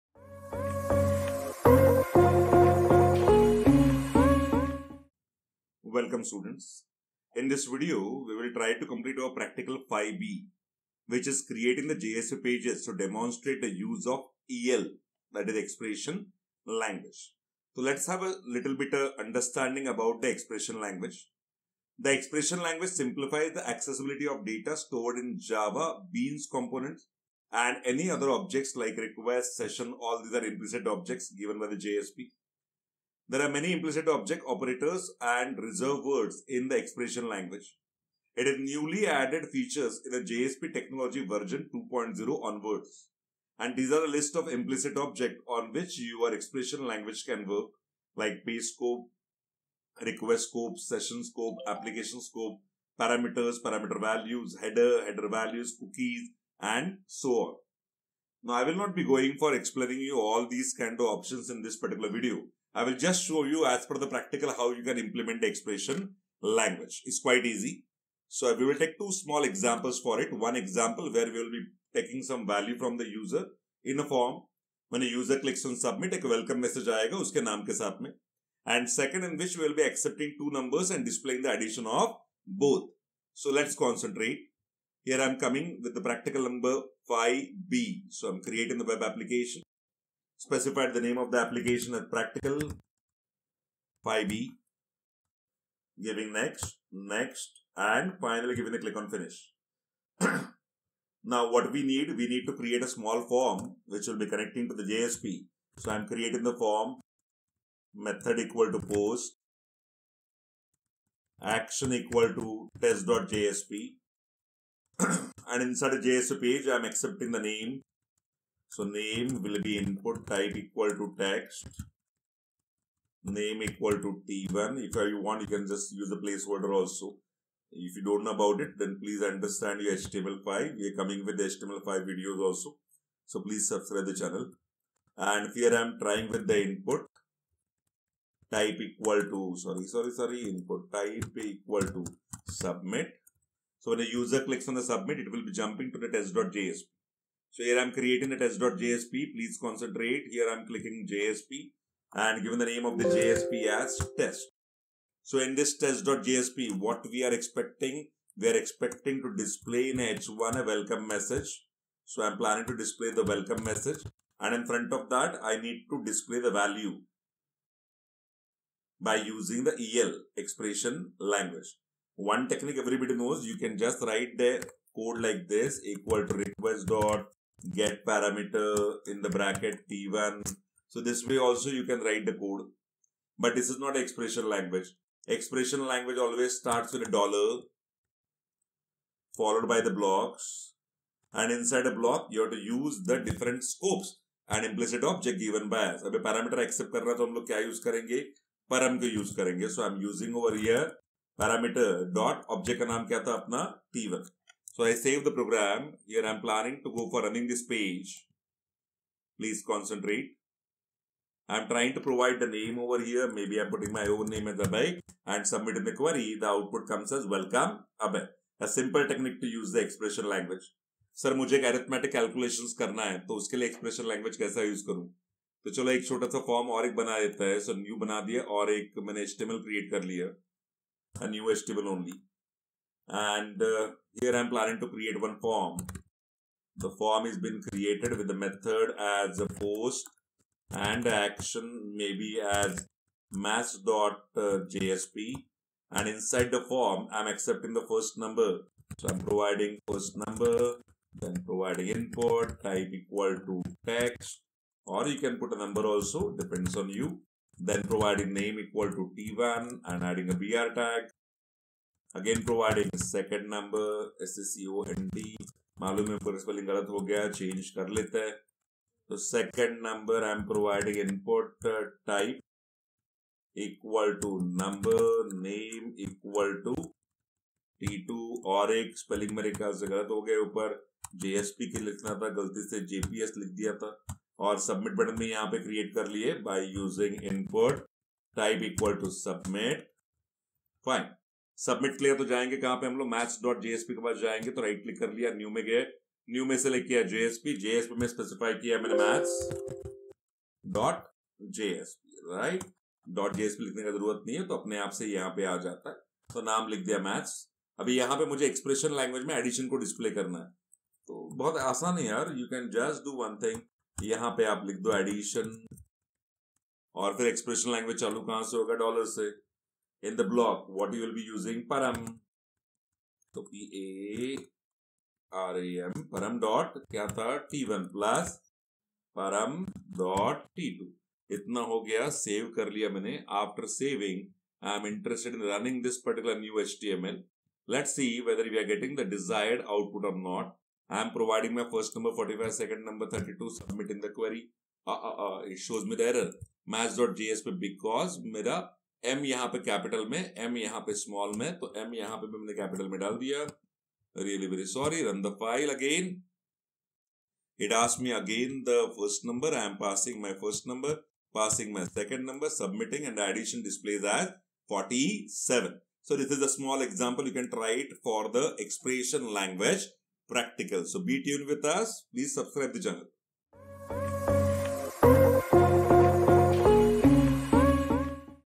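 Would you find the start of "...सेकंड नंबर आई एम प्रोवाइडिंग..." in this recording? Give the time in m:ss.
4:29.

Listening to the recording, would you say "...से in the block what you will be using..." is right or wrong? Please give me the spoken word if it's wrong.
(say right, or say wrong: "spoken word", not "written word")
right.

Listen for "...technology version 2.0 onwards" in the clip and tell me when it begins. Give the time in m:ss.
0:40.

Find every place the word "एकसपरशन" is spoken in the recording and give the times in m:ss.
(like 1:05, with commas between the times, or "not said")
3:43, 5:08, 5:17, 6:08.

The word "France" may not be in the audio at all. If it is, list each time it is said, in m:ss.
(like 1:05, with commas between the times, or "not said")
not said.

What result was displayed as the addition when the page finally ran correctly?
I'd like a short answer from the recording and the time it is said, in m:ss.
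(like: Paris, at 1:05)
47, at 6:04.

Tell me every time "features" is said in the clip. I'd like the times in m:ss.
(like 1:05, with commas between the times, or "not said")
0:39.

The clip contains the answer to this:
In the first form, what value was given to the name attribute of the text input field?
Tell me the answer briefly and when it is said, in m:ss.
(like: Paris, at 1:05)
T1, at 2:03.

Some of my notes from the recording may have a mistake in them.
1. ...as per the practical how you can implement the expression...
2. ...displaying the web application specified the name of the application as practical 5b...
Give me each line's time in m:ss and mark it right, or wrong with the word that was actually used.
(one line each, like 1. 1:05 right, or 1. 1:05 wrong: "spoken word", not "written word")
1. 1:03 right
2. 1:28 wrong: "creating", not "displaying".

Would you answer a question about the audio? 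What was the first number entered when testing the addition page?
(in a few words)
45.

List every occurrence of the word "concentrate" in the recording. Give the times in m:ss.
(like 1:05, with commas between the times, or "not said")
1:23, 2:29, 3:29.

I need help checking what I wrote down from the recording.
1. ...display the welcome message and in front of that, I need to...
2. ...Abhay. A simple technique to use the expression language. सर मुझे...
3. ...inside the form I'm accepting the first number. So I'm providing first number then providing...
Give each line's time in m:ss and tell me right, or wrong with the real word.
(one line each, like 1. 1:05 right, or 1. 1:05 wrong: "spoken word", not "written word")
1. 2:42 right
2. 3:38 right
3. 4:06 right.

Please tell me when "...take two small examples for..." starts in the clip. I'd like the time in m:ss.
1:08.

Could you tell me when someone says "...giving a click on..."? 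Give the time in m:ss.
1:38.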